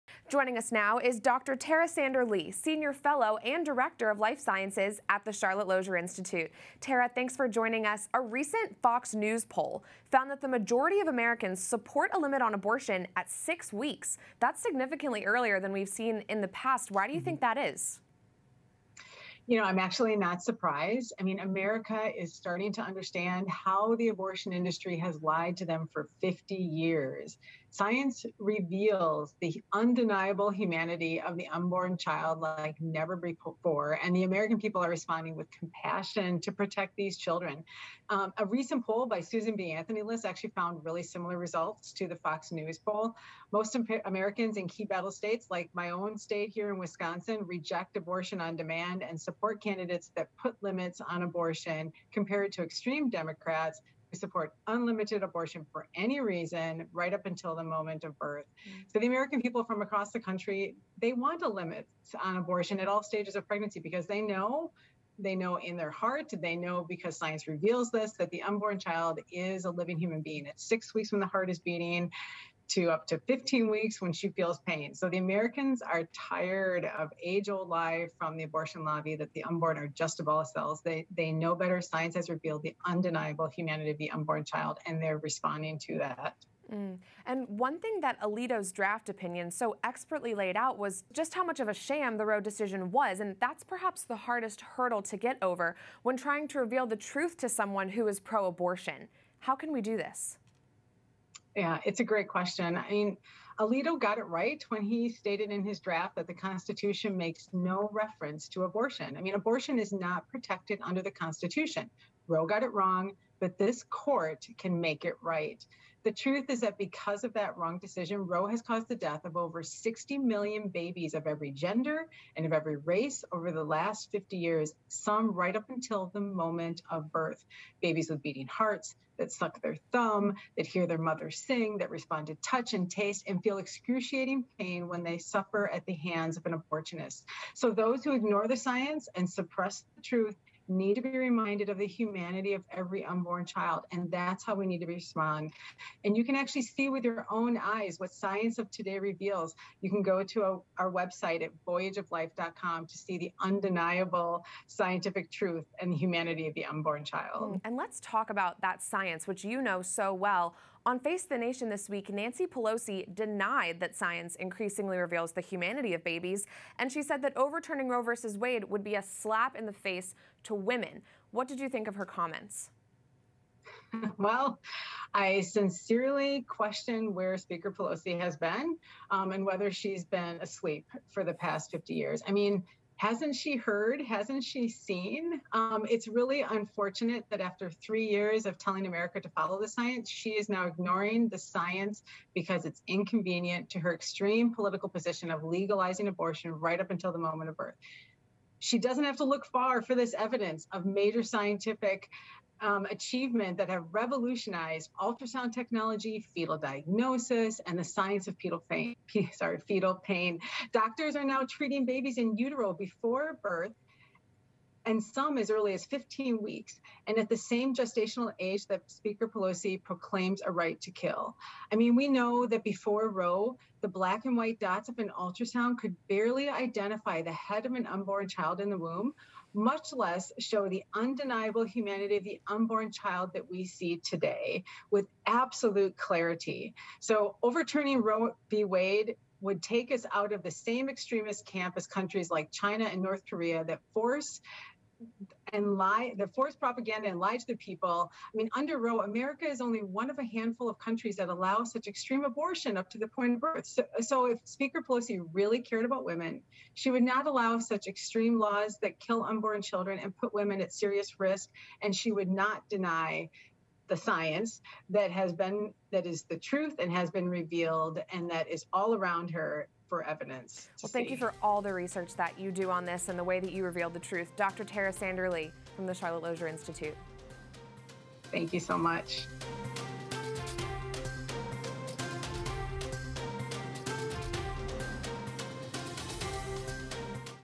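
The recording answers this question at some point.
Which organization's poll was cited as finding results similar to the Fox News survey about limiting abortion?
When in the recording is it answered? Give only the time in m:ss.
0:39.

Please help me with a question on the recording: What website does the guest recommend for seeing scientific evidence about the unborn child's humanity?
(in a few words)
voyageoflife.com.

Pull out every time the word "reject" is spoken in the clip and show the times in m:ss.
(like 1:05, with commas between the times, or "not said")
0:47.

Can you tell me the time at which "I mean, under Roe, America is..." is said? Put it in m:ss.
4:08.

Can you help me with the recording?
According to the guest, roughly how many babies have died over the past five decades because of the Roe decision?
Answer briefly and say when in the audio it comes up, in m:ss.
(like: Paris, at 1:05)
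over 60 million, at 1:59.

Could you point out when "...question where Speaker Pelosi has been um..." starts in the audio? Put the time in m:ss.
2:56.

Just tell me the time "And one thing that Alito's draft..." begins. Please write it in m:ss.
1:27.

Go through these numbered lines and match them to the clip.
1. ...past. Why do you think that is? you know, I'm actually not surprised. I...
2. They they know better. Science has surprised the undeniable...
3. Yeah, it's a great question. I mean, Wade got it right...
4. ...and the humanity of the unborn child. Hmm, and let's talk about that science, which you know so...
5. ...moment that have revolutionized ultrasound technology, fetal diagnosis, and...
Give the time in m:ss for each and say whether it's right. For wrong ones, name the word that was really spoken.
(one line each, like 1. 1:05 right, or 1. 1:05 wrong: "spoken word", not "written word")
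1. 0:16 right
2. 1:20 wrong: "revealed", not "surprised"
3. 1:41 wrong: "Alito", not "Wade"
4. 2:35 right
5. 3:22 wrong: "achievement", not "moment".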